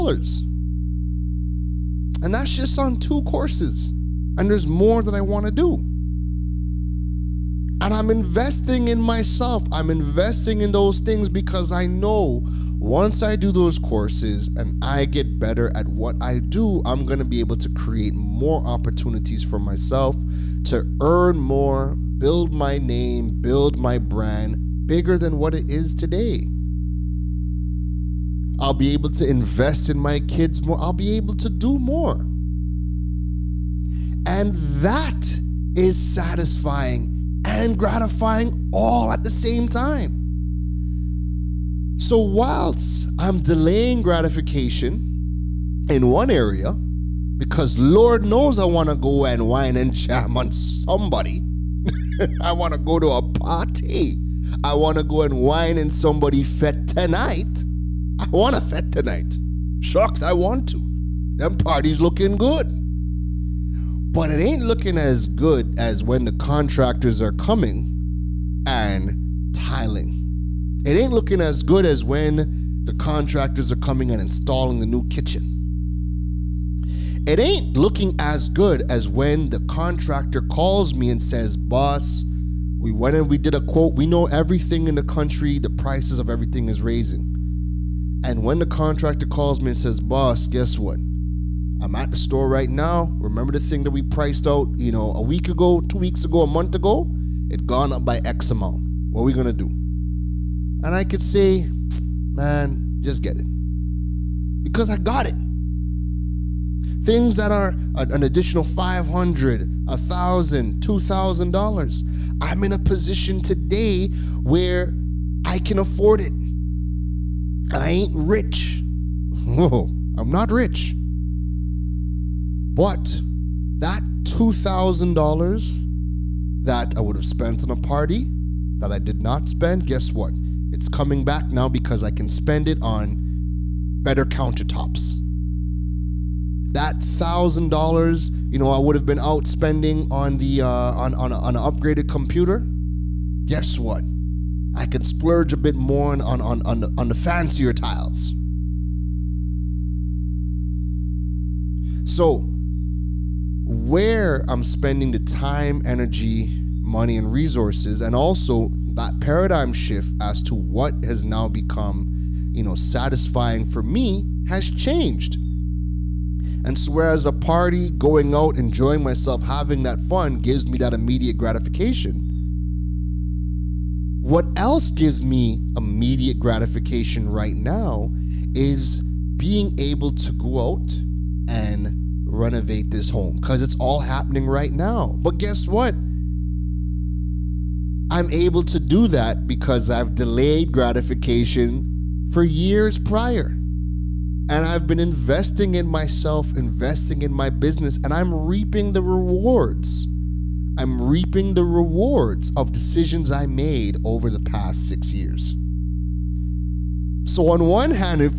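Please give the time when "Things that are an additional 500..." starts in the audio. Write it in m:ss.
1:47.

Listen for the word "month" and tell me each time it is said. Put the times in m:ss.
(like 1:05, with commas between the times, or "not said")
1:36.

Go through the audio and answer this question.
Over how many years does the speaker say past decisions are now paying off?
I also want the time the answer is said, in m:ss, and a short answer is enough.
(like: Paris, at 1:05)
6, at 3:24.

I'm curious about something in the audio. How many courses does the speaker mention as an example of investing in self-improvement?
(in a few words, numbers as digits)
2.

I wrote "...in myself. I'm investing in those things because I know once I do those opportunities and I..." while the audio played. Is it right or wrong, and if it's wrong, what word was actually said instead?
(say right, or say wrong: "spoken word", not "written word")
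wrong: "courses", not "opportunities".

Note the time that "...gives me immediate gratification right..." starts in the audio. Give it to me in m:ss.
2:54.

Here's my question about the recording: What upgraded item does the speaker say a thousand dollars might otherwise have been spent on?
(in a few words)
Computer.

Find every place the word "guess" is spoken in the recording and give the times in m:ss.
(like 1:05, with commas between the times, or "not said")
1:30, 2:09, 2:23, 3:05.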